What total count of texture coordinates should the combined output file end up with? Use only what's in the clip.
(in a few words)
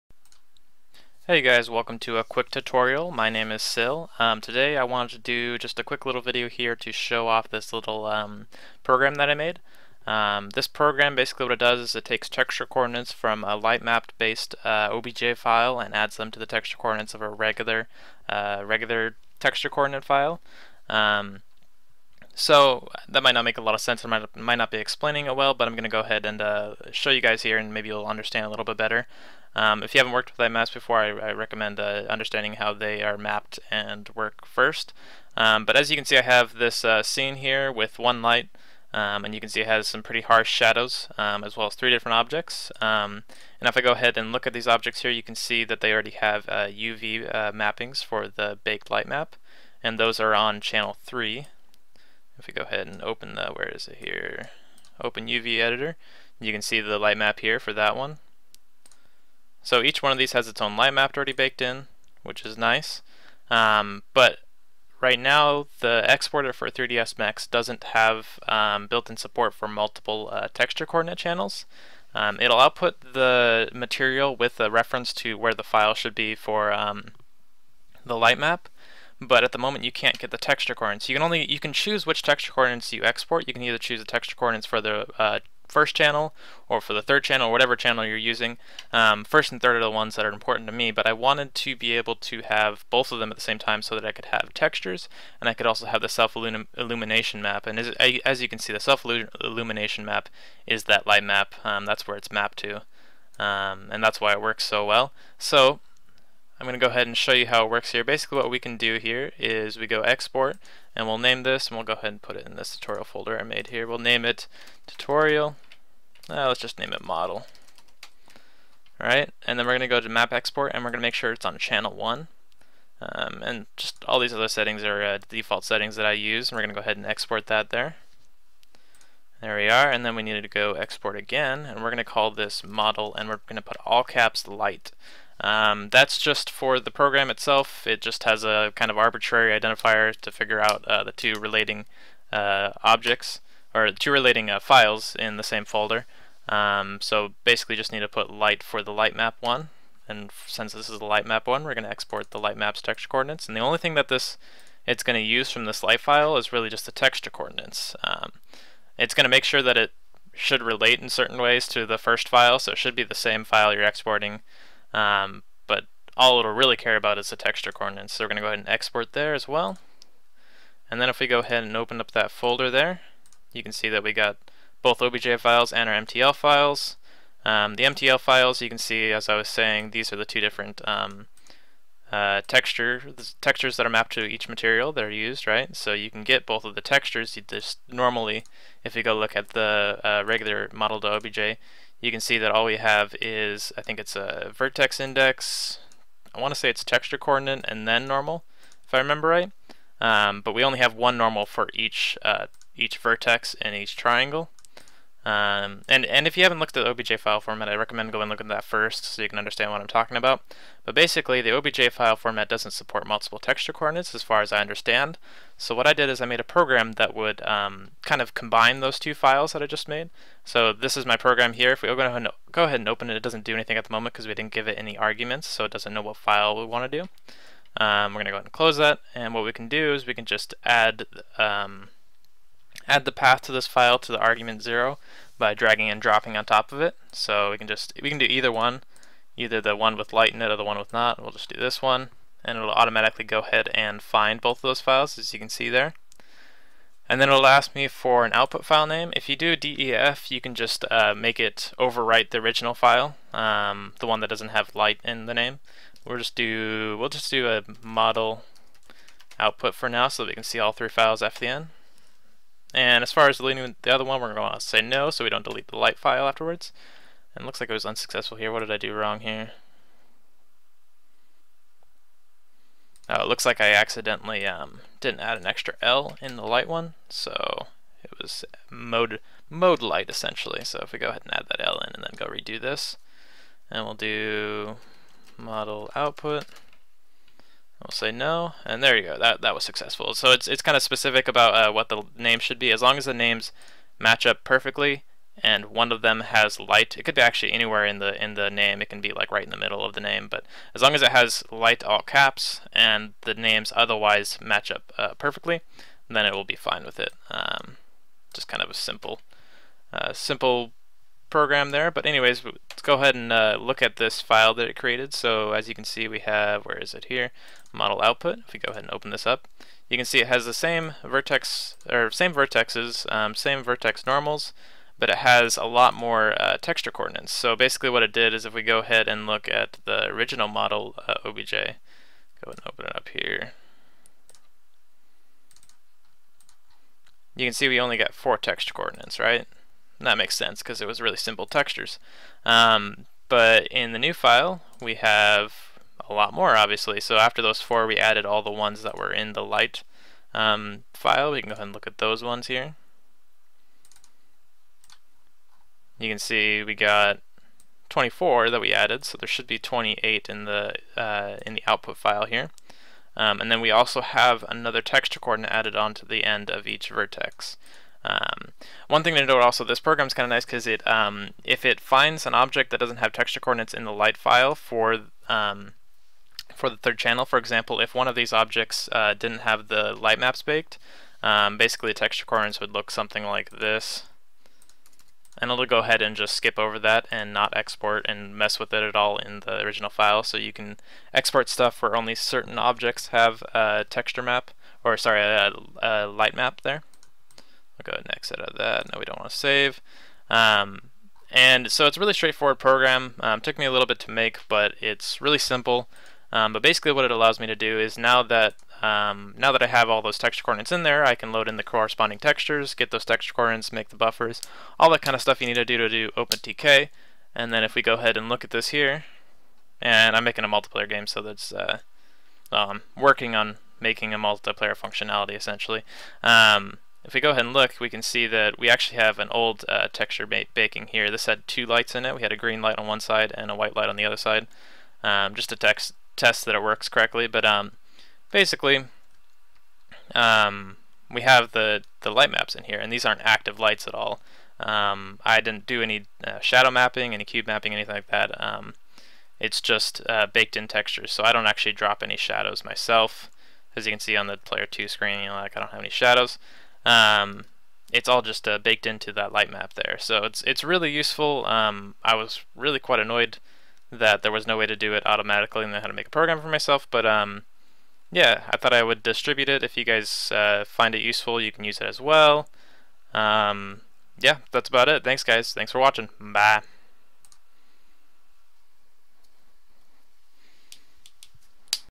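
28.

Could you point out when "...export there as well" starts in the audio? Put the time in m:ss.
2:48.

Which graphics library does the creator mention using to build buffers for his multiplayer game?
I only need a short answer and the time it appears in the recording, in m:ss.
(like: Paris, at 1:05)
OpenTK, at 6:56.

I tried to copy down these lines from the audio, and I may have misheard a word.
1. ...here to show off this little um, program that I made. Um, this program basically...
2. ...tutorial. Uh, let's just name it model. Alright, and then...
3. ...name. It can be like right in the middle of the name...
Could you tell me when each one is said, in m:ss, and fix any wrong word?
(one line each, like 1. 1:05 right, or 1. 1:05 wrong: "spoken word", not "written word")
1. 0:06 right
2. 1:54 right
3. 4:58 right.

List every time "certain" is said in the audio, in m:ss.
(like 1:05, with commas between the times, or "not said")
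2:41, 6:32.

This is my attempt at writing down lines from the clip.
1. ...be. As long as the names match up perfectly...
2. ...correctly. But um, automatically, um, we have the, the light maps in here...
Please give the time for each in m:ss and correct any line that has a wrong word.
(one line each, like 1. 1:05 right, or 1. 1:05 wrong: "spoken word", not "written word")
1. 4:52 right
2. 7:16 wrong: "basically", not "automatically".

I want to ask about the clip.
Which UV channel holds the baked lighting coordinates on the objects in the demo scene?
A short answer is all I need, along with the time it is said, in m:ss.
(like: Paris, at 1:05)
3, at 0:50.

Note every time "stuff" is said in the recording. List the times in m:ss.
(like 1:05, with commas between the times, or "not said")
6:31, 6:55.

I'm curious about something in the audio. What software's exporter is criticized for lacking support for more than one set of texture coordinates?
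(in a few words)
3ds Max.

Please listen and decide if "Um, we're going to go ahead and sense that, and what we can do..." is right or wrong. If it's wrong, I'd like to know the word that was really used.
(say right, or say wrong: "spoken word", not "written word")
wrong: "close", not "sense".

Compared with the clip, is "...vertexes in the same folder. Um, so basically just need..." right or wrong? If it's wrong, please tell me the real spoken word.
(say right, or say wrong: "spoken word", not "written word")
wrong: "files", not "vertexes".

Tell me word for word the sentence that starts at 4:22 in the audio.
And as far as deleting the other one, we're going to say no so we don't delete the light file afterwards.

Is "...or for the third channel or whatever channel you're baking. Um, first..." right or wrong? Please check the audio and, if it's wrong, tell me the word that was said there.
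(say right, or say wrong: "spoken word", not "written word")
wrong: "using", not "baking".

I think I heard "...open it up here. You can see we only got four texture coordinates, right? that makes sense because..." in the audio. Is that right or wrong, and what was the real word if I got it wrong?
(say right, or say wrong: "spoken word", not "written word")
right.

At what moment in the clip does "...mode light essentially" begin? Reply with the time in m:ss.
4:39.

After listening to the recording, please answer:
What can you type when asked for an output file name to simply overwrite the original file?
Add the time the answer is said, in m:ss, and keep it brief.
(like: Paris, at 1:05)
DEF, at 4:09.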